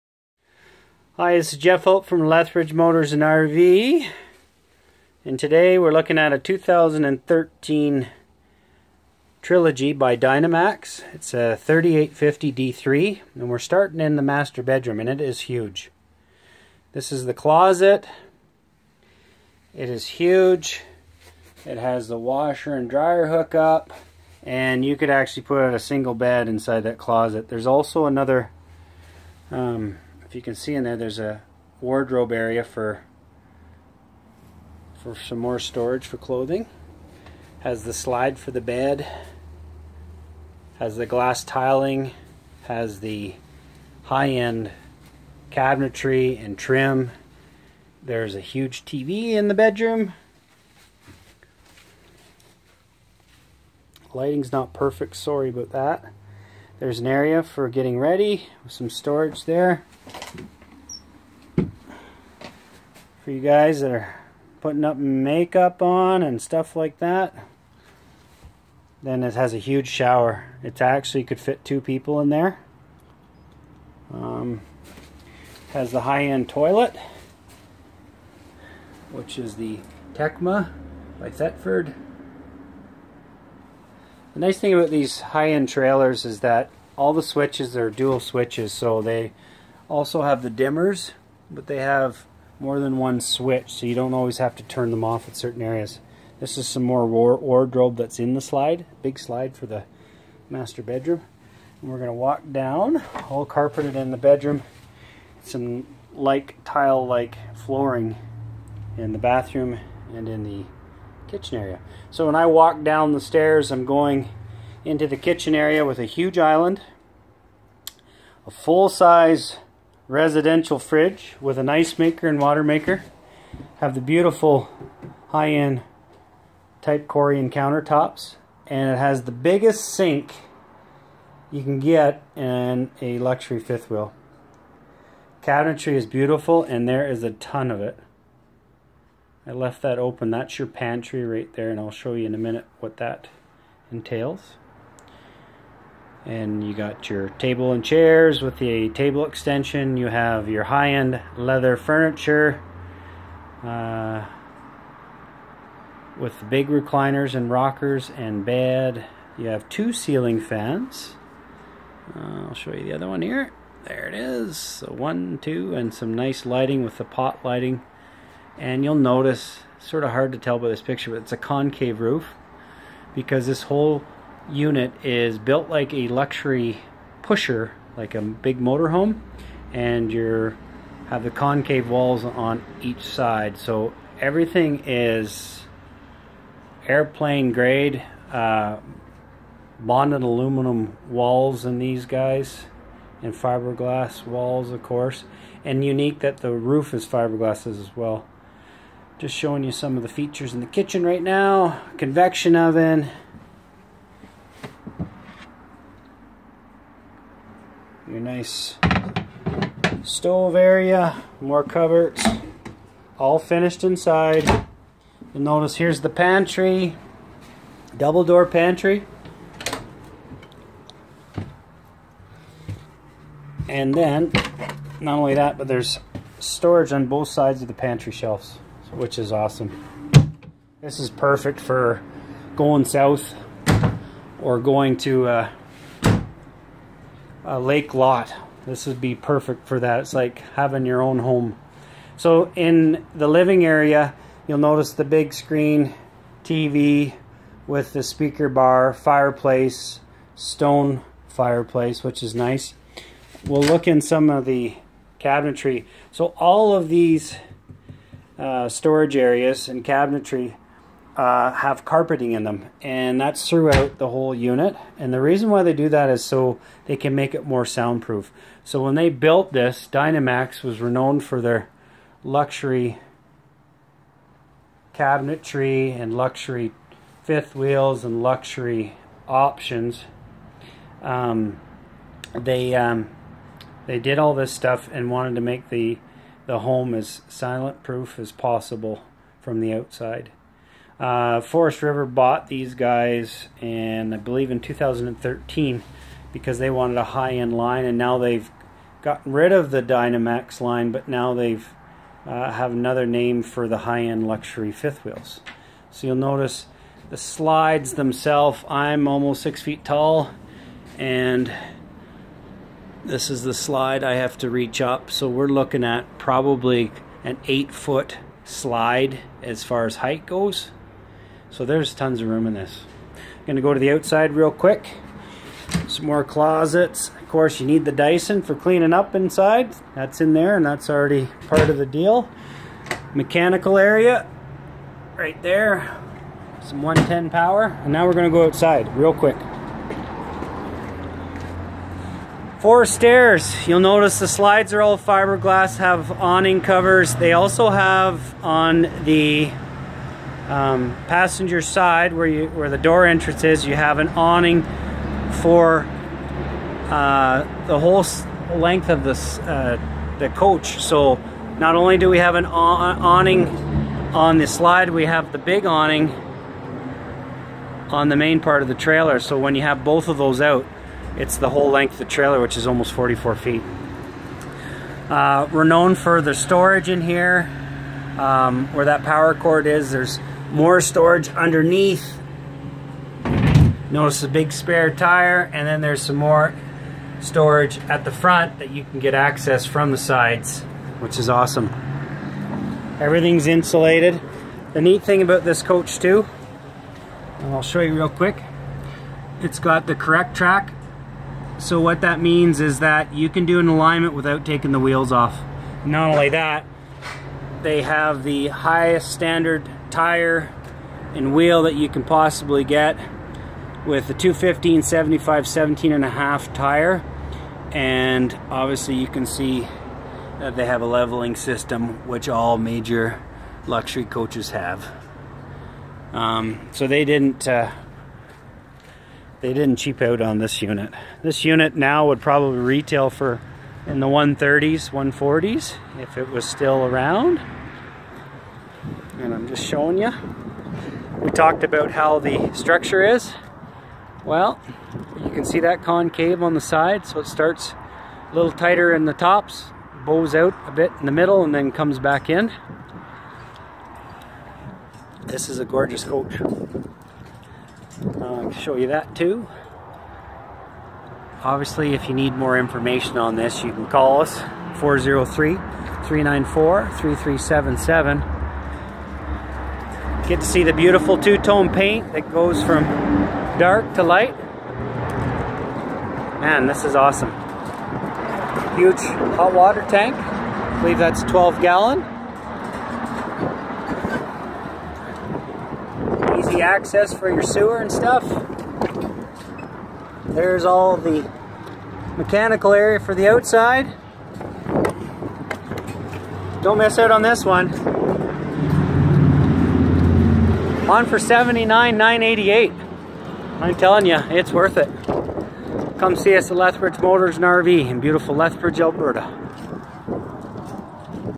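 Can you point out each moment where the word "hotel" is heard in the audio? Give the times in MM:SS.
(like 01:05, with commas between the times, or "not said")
not said.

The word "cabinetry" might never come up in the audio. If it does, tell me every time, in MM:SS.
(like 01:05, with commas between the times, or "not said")
00:45, 02:15, 04:15, 04:19, 04:34.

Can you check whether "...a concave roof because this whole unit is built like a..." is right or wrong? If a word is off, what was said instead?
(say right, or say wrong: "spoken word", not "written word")
right.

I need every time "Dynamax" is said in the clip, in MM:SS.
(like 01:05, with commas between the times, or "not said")
00:10, 04:29, 04:59.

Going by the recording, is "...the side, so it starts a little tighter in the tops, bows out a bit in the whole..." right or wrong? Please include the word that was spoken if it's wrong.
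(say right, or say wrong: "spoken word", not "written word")
wrong: "middle", not "whole".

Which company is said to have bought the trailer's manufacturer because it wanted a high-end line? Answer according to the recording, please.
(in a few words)
Forest River.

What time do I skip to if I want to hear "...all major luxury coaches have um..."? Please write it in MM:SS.
07:02.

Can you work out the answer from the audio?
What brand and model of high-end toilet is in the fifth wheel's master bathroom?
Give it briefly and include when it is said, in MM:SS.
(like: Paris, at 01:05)
Tecma by Thetford, at 01:20.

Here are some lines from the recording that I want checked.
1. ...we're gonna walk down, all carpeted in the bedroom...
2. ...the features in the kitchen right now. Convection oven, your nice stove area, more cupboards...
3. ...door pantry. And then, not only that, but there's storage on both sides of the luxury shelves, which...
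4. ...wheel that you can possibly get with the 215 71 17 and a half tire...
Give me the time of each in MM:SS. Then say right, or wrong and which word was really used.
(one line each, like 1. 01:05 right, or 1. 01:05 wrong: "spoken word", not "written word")
1. 01:41 right
2. 03:20 right
3. 03:38 wrong: "pantry", not "luxury"
4. 06:51 wrong: "75", not "71".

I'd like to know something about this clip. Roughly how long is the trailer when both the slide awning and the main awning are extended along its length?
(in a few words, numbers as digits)
almost 44 feet.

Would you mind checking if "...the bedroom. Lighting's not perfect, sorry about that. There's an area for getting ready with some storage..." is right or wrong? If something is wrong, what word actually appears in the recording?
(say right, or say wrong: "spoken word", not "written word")
right.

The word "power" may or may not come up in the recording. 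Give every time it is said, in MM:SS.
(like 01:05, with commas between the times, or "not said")
05:37, 06:19.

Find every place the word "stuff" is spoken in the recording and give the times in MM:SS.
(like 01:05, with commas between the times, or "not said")
01:06, 04:44, 08:07.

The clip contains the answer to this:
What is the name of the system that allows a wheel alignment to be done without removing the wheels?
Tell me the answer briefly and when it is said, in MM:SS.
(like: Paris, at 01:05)
CorrecTrack, at 06:39.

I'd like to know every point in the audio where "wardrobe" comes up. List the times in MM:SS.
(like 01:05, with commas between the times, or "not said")
00:31, 01:37.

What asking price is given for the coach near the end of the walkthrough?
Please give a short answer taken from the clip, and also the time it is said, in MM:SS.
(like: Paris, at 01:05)
79,988, at 08:21.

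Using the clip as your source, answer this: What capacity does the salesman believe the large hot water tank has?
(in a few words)
12 gallon.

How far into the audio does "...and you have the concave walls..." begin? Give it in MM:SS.
02:59.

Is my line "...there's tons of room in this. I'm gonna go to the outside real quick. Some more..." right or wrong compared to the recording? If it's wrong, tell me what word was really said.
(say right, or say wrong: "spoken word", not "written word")
right.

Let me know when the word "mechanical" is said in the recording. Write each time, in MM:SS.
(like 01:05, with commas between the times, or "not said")
05:33, 08:12.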